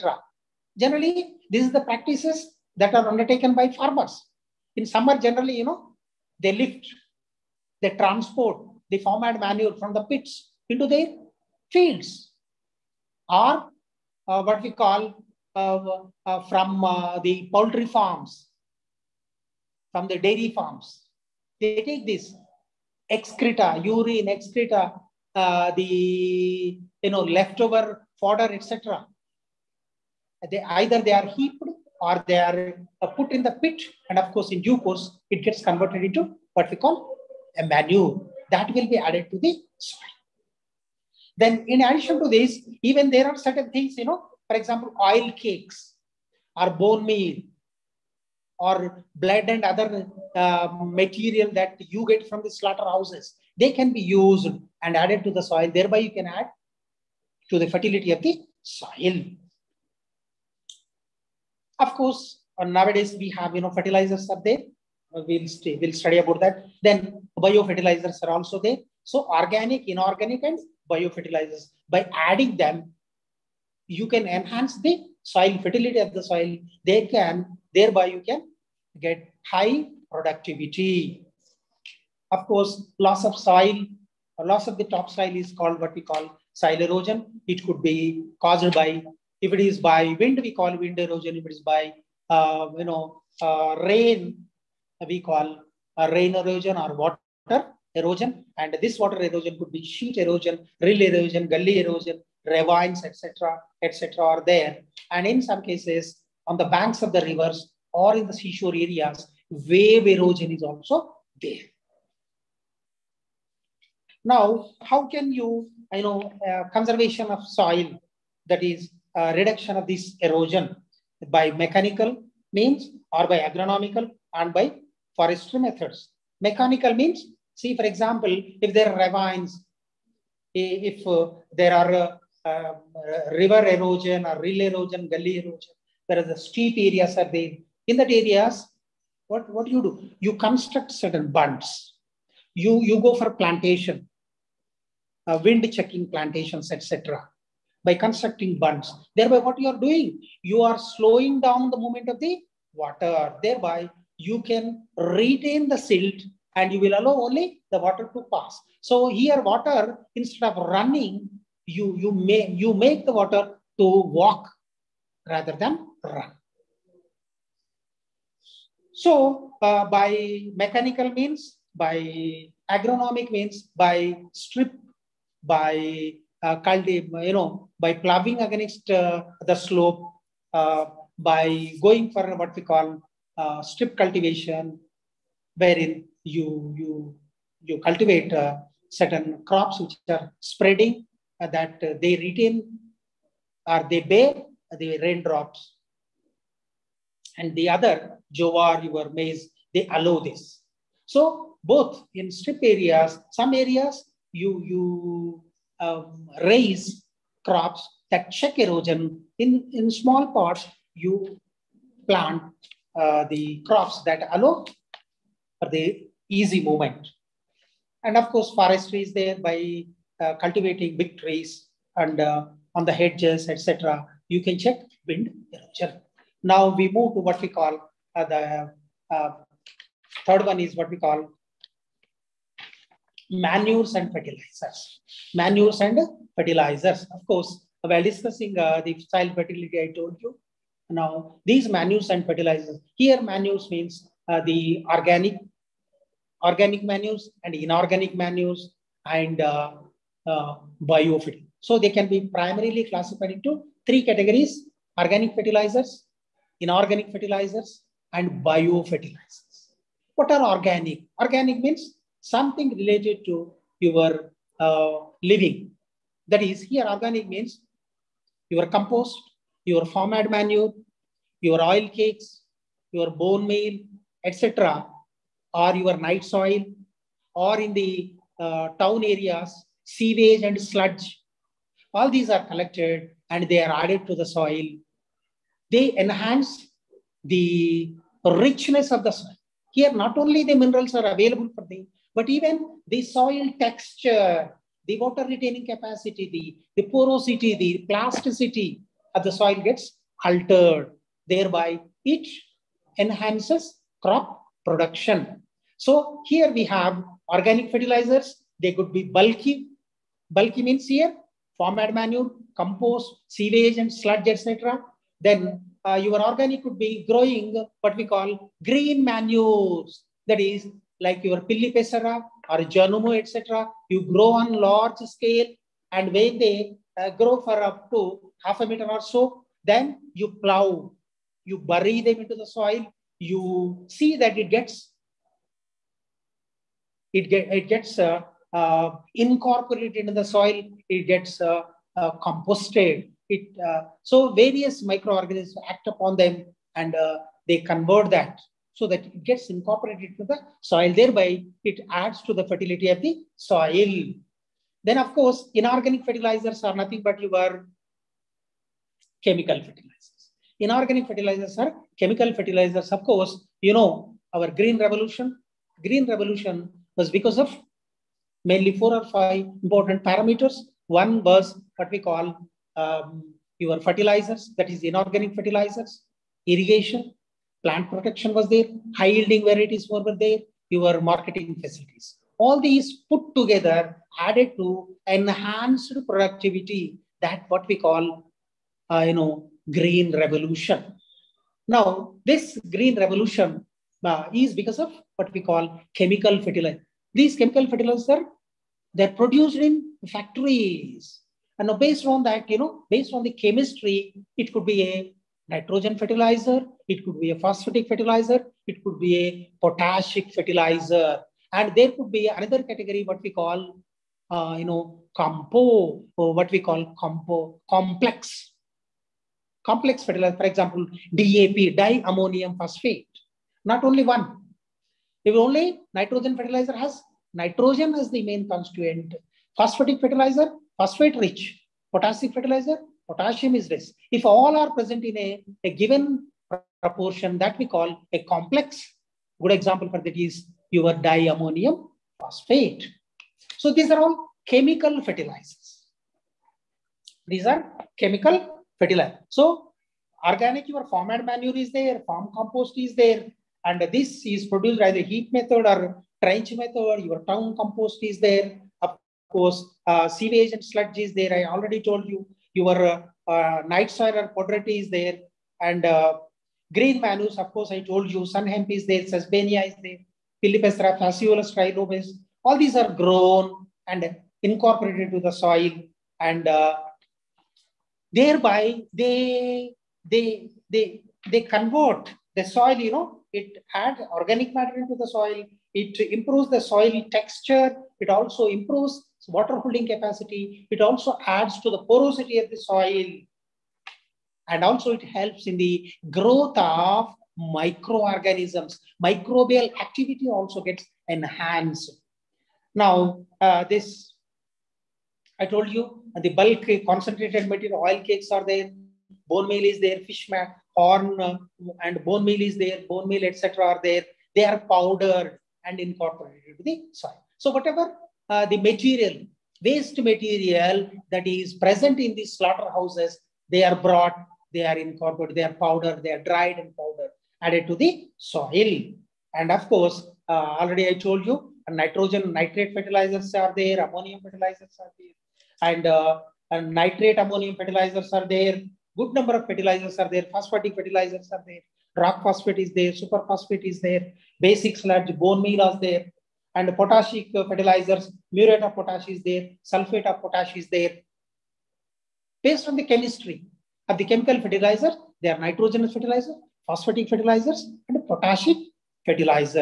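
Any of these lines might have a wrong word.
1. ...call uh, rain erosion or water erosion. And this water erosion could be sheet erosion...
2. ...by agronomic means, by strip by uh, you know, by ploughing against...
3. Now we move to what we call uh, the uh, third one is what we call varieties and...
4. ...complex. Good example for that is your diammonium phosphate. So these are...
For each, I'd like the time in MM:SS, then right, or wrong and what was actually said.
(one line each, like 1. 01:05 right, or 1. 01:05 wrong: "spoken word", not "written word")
1. 01:35 right
2. 02:51 right
3. 03:46 wrong: "manures", not "varieties"
4. 07:18 right.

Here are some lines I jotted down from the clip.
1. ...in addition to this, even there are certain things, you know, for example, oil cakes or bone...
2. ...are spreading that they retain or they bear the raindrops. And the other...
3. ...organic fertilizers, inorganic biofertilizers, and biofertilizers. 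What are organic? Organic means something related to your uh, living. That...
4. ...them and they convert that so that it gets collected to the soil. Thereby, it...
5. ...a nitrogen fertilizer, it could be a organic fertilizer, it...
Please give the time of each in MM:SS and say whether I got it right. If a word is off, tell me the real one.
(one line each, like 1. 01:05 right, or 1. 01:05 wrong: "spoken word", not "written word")
1. 00:41 right
2. 03:10 right
3. 04:14 wrong: "fertilizers", not "biofertilizers"
4. 05:46 wrong: "incorporated", not "collected"
5. 06:44 wrong: "phosphatic", not "organic".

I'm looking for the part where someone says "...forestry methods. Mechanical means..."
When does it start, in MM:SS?
02:05.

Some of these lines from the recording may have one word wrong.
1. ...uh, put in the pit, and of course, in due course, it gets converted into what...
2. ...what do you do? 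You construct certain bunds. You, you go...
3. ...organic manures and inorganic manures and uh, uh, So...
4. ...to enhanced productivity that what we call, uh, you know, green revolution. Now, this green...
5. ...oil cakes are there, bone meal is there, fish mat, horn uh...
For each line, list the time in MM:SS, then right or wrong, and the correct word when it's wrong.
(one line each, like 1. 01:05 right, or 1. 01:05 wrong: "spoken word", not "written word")
1. 00:33 right
2. 02:19 right
3. 04:06 right
4. 06:24 right
5. 08:27 right.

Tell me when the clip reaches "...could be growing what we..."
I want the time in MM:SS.
05:16.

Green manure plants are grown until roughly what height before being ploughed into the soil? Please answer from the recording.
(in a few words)
Half a meter.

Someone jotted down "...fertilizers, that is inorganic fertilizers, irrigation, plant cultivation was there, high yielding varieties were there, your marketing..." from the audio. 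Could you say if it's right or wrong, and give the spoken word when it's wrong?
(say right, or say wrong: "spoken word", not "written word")
wrong: "protection", not "cultivation".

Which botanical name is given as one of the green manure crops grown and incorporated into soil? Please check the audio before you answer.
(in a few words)
Phaseolus trilobus.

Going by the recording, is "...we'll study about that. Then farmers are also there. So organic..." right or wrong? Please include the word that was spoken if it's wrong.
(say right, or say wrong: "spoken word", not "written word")
wrong: "biofertilizers", not "farmers".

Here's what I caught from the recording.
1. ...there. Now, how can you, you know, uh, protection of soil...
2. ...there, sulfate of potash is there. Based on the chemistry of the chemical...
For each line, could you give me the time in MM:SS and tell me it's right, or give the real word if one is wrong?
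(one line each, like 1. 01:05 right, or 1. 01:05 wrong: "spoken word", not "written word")
1. 01:51 wrong: "conservation", not "protection"
2. 09:09 right.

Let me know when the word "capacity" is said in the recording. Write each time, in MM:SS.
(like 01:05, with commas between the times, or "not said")
04:55, 08:09.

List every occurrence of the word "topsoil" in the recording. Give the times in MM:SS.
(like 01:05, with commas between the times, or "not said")
01:24.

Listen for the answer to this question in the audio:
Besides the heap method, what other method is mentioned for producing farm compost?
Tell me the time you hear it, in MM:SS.
07:36.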